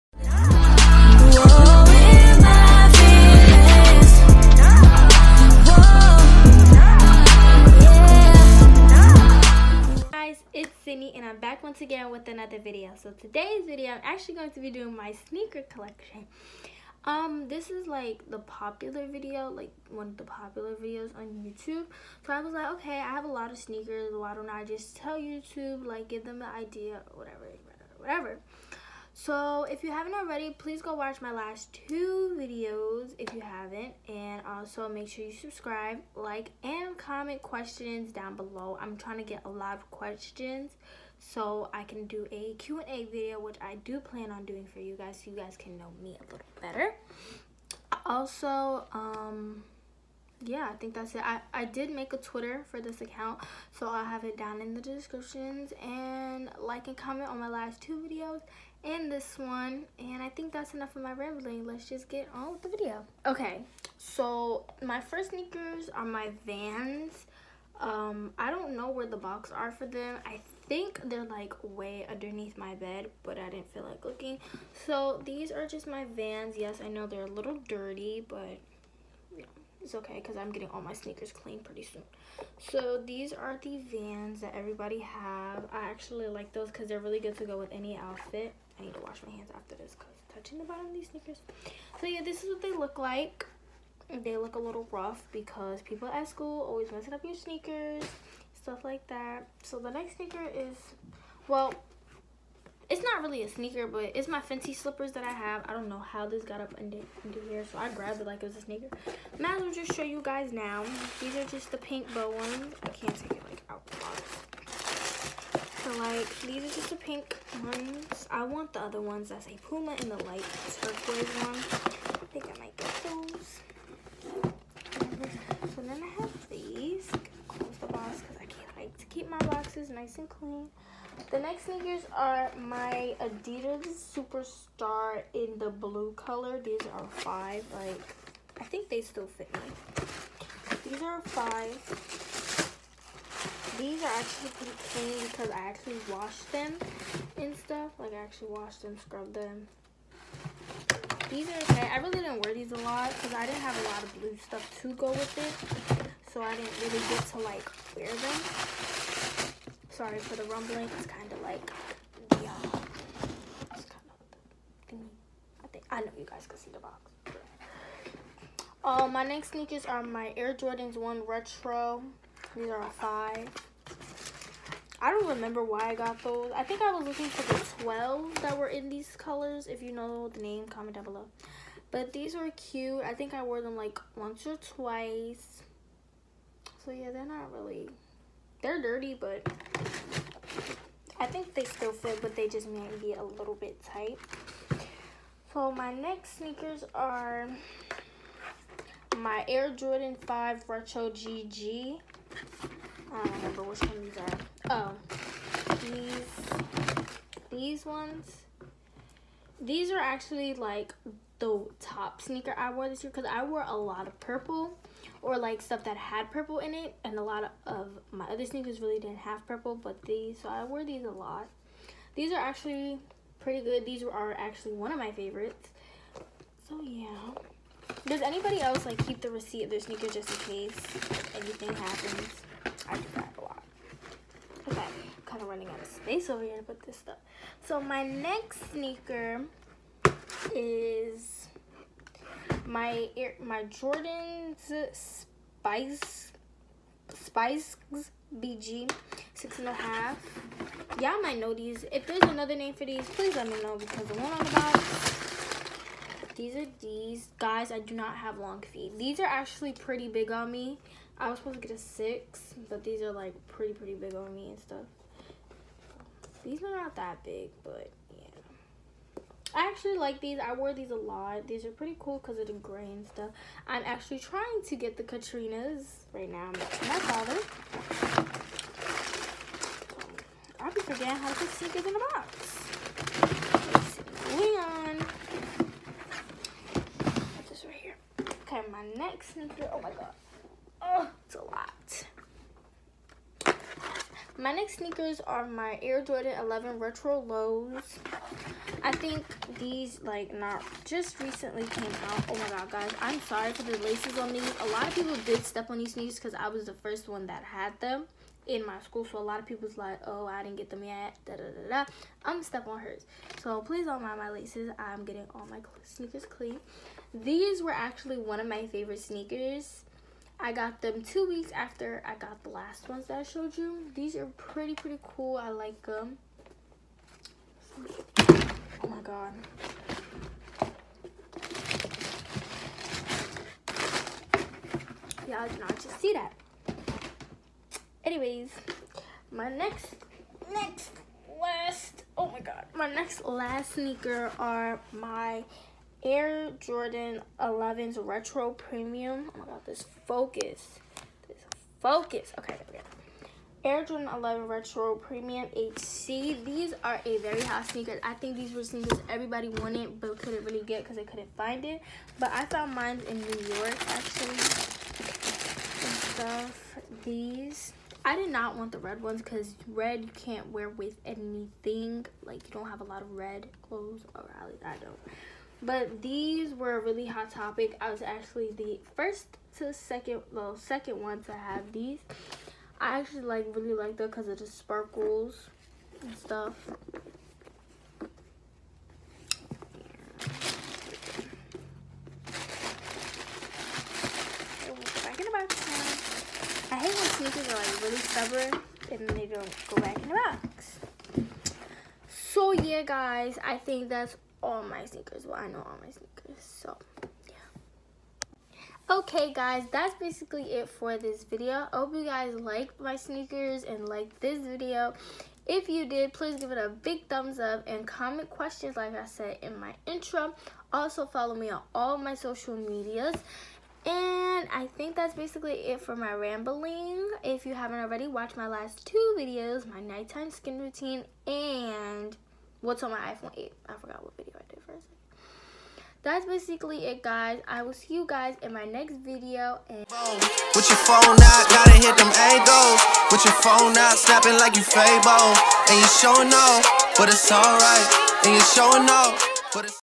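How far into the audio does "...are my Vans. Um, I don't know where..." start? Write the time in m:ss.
1:05.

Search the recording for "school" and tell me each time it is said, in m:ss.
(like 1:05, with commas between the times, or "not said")
1:36, 5:08.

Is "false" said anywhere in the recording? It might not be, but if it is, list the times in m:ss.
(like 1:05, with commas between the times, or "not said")
not said.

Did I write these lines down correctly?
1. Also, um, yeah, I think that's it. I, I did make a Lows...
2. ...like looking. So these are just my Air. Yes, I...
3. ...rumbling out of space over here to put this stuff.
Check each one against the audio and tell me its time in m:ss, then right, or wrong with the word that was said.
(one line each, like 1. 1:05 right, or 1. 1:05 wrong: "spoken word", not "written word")
1. 0:48 wrong: "Twitter", not "Lows"
2. 1:13 wrong: "Vans", not "Air"
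3. 3:55 wrong: "running", not "rumbling".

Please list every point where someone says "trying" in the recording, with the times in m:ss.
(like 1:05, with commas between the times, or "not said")
0:38, 4:34.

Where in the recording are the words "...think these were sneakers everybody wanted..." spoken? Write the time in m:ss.
5:58.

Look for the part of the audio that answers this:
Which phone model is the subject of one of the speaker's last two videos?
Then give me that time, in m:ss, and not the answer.
7:12.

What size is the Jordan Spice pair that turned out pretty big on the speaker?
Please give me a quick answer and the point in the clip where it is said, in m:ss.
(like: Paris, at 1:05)
6 and a half, at 4:09.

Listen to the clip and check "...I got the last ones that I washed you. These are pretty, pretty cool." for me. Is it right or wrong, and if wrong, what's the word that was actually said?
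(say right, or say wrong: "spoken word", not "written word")
wrong: "showed", not "washed".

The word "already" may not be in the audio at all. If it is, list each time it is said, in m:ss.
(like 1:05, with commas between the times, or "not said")
0:30, 7:07.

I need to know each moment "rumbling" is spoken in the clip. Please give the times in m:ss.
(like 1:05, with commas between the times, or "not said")
2:40.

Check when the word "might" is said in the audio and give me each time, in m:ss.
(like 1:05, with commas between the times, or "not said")
1:49, 3:12, 4:11.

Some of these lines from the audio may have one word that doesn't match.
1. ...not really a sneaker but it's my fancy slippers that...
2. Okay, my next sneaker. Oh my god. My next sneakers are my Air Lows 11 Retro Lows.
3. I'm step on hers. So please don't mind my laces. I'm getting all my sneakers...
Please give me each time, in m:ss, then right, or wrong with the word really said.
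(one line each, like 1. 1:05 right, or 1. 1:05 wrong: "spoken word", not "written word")
1. 1:43 right
2. 4:48 wrong: "Jordan", not "Lows"
3. 5:12 right.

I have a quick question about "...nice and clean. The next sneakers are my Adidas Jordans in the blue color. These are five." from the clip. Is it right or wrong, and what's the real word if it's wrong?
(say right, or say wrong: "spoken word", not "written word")
wrong: "Superstar", not "Jordans".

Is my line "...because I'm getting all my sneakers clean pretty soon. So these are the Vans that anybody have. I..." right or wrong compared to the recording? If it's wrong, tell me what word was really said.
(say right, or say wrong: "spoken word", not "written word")
wrong: "everybody", not "anybody".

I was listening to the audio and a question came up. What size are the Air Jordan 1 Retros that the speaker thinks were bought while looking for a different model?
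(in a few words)
5.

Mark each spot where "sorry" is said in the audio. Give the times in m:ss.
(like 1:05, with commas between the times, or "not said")
2:40, 5:03.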